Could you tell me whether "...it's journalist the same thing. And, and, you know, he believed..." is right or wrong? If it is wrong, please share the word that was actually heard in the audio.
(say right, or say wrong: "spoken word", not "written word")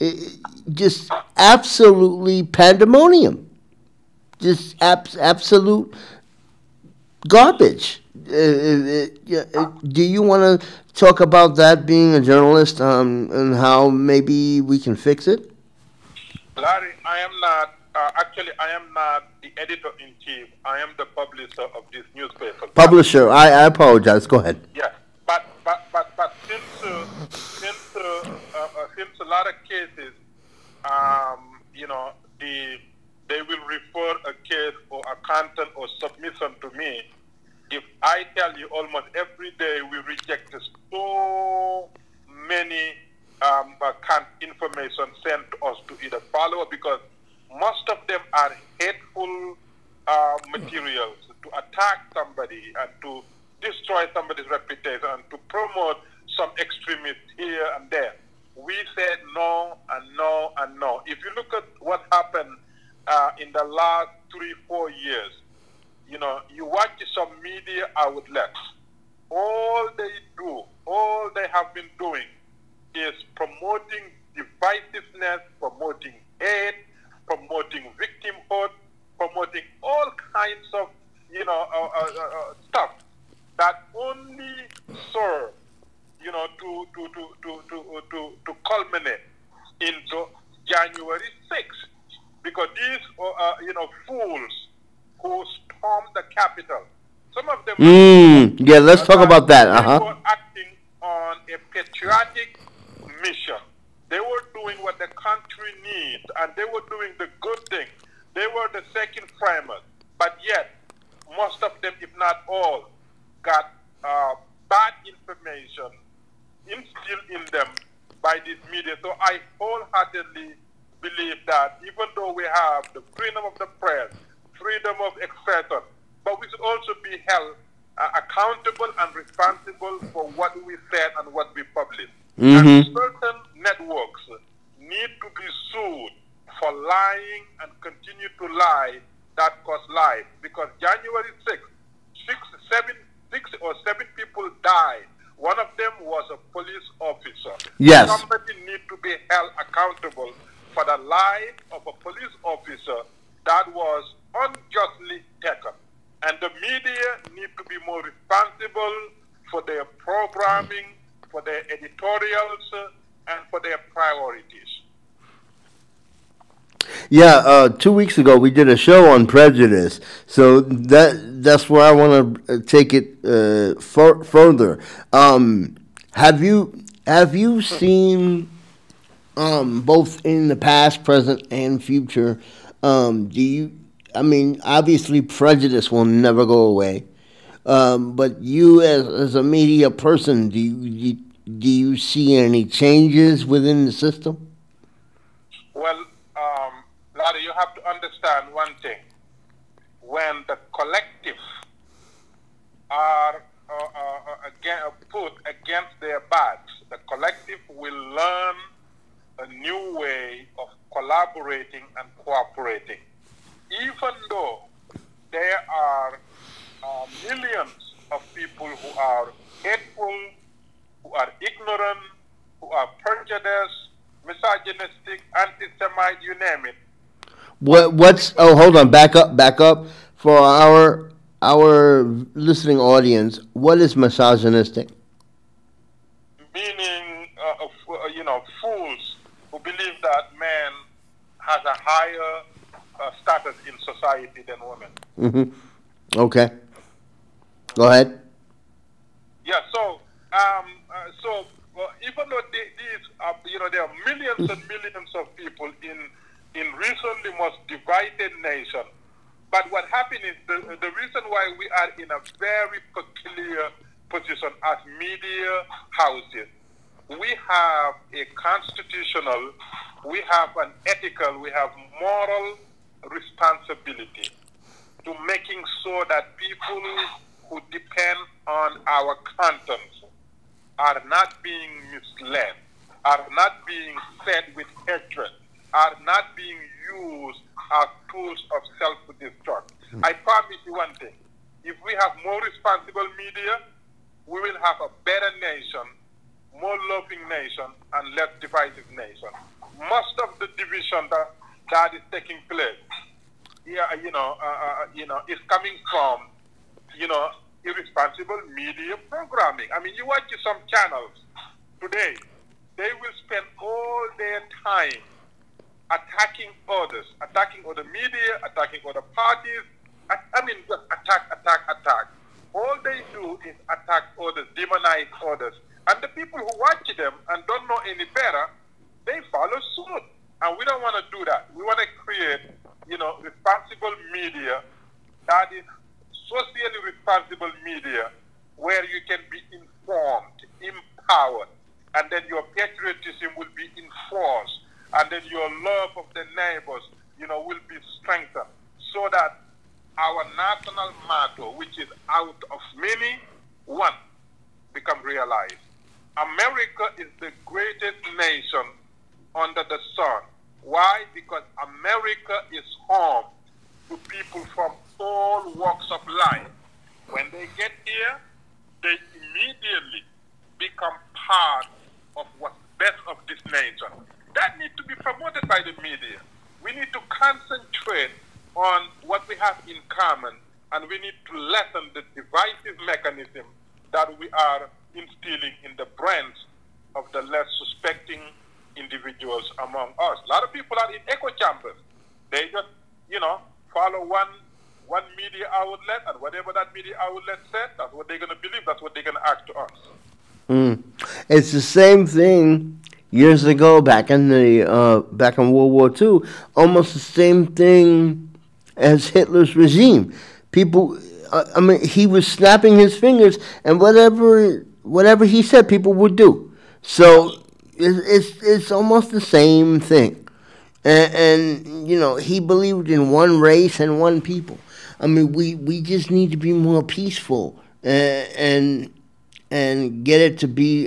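wrong: "almost", not "journalist".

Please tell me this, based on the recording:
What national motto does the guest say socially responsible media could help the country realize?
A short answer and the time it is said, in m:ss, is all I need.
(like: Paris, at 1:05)
Out of many, one, at 5:52.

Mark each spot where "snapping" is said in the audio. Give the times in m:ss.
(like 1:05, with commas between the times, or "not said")
6:52.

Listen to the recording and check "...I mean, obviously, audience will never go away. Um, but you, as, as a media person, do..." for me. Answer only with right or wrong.
wrong.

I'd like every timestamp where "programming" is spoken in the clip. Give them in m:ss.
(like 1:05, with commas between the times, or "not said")
2:39, 5:09.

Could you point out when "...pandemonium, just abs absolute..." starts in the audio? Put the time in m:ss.
0:02.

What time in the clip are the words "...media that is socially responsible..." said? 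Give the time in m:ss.
5:34.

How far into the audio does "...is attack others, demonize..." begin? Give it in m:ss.
5:23.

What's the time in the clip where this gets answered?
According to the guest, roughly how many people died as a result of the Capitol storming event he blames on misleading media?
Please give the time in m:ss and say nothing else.
2:22.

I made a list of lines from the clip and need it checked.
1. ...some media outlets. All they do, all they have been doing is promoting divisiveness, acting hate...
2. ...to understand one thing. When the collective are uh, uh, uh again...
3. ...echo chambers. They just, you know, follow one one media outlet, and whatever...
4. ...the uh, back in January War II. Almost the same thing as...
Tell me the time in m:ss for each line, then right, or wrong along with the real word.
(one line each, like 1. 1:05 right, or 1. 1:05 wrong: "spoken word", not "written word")
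1. 1:07 wrong: "promoting", not "acting"
2. 3:17 right
3. 6:31 right
4. 6:44 wrong: "World", not "January".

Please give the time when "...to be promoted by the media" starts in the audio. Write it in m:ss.
6:14.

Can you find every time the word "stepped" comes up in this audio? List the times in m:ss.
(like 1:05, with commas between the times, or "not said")
not said.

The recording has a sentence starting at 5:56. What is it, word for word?
America is the greatest nation under the sun why?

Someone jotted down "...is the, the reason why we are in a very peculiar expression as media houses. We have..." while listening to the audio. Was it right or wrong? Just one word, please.
wrong.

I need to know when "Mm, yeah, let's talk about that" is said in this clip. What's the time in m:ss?
1:37.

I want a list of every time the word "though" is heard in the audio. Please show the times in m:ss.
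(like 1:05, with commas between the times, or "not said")
2:02, 3:34, 4:12.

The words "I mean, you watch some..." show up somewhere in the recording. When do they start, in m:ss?
5:09.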